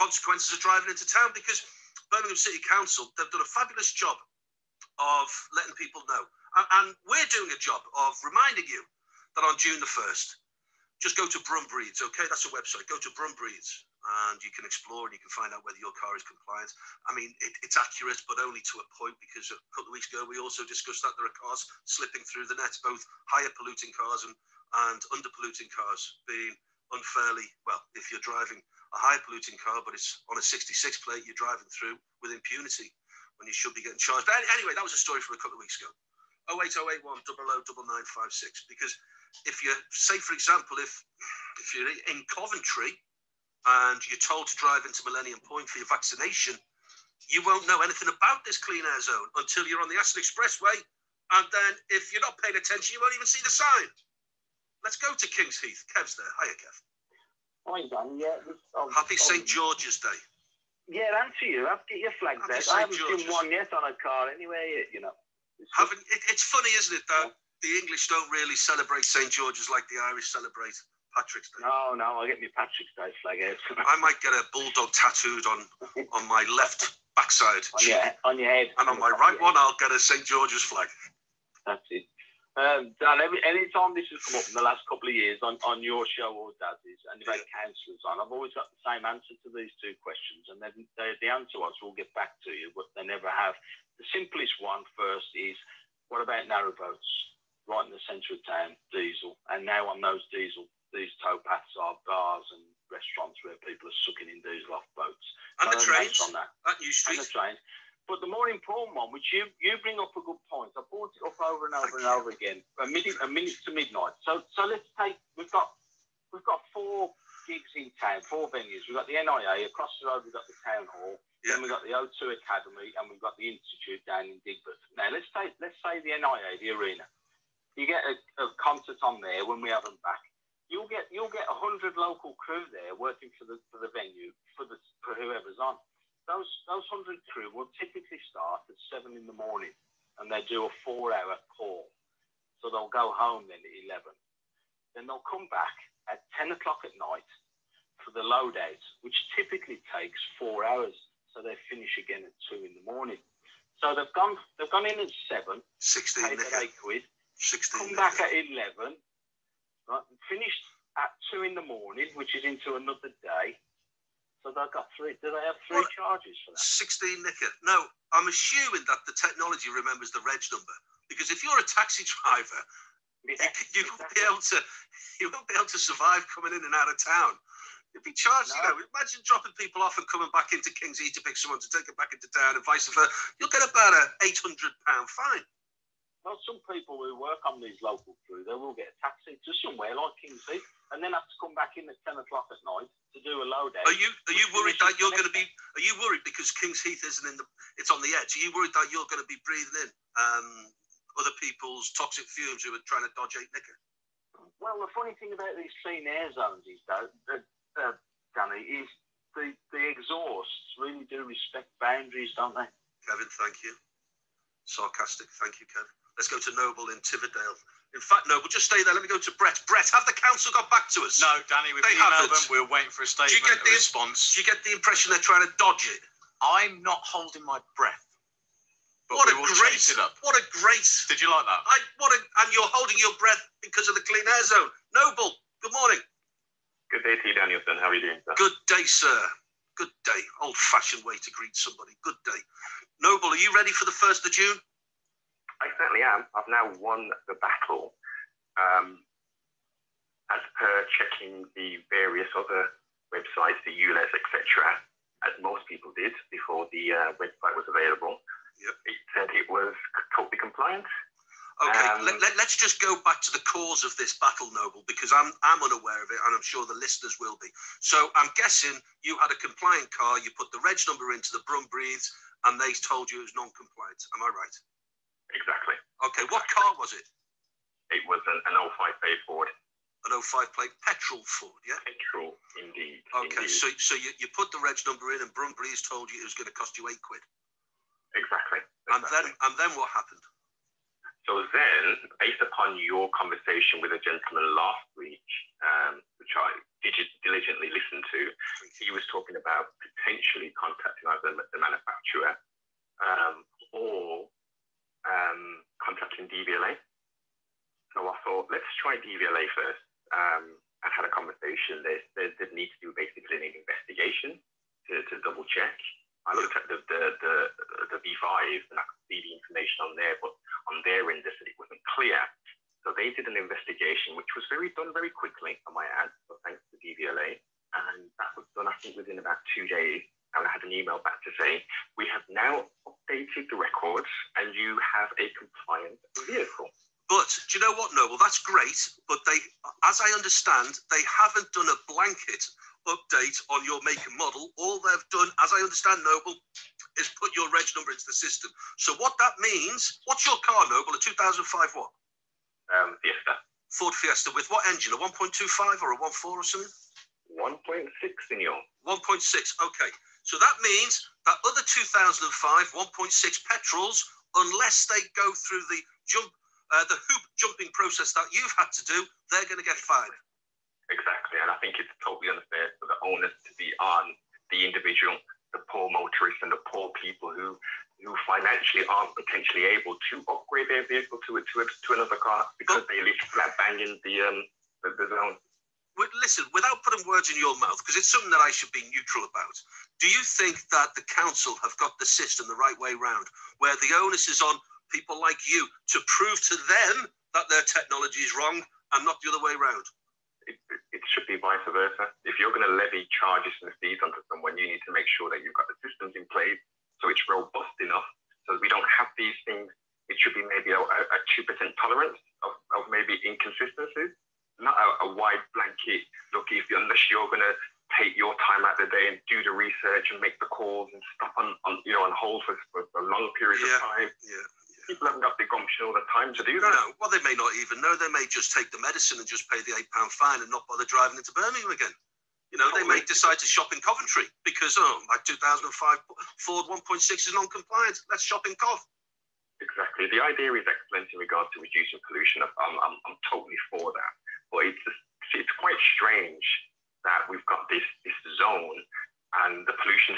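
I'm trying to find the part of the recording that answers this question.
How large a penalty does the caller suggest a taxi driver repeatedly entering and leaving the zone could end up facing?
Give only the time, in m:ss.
3:04.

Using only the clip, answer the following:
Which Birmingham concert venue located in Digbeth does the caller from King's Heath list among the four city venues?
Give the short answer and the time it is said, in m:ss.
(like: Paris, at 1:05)
The Institute, at 2:03.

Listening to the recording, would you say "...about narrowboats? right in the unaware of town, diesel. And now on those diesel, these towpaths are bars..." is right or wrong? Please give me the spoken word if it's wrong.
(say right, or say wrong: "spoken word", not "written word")
wrong: "centre", not "unaware".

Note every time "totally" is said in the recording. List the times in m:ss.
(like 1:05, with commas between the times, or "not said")
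4:20, 6:12, 7:23.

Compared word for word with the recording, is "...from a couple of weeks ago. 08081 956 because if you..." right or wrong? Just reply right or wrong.
right.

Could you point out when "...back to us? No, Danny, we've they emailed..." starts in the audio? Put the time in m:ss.
3:40.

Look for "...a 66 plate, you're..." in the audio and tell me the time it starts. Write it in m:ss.
0:30.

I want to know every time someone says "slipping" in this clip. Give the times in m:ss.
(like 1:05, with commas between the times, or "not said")
0:21.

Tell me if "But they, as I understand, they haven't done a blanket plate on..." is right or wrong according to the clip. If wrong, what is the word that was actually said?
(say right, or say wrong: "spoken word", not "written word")
wrong: "update", not "plate".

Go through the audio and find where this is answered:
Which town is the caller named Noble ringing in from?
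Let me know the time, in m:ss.
3:37.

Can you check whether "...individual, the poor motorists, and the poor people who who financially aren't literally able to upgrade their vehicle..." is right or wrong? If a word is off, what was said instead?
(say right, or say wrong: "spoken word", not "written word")
wrong: "potentially", not "literally".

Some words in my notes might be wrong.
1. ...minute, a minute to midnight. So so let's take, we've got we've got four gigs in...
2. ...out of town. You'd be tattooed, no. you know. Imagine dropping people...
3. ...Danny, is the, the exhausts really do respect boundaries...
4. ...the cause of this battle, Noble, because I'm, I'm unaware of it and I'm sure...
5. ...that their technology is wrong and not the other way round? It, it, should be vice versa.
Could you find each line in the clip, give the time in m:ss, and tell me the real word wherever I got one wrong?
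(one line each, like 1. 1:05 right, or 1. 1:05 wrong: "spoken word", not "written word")
1. 1:52 right
2. 2:56 wrong: "charged", not "tattooed"
3. 3:28 right
4. 4:23 right
5. 6:37 right.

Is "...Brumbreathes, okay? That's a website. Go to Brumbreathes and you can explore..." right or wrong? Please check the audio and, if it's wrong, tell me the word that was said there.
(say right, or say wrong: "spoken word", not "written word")
right.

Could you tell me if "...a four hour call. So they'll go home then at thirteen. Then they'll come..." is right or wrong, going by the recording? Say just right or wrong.
wrong.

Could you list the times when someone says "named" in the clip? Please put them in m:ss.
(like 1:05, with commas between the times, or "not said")
not said.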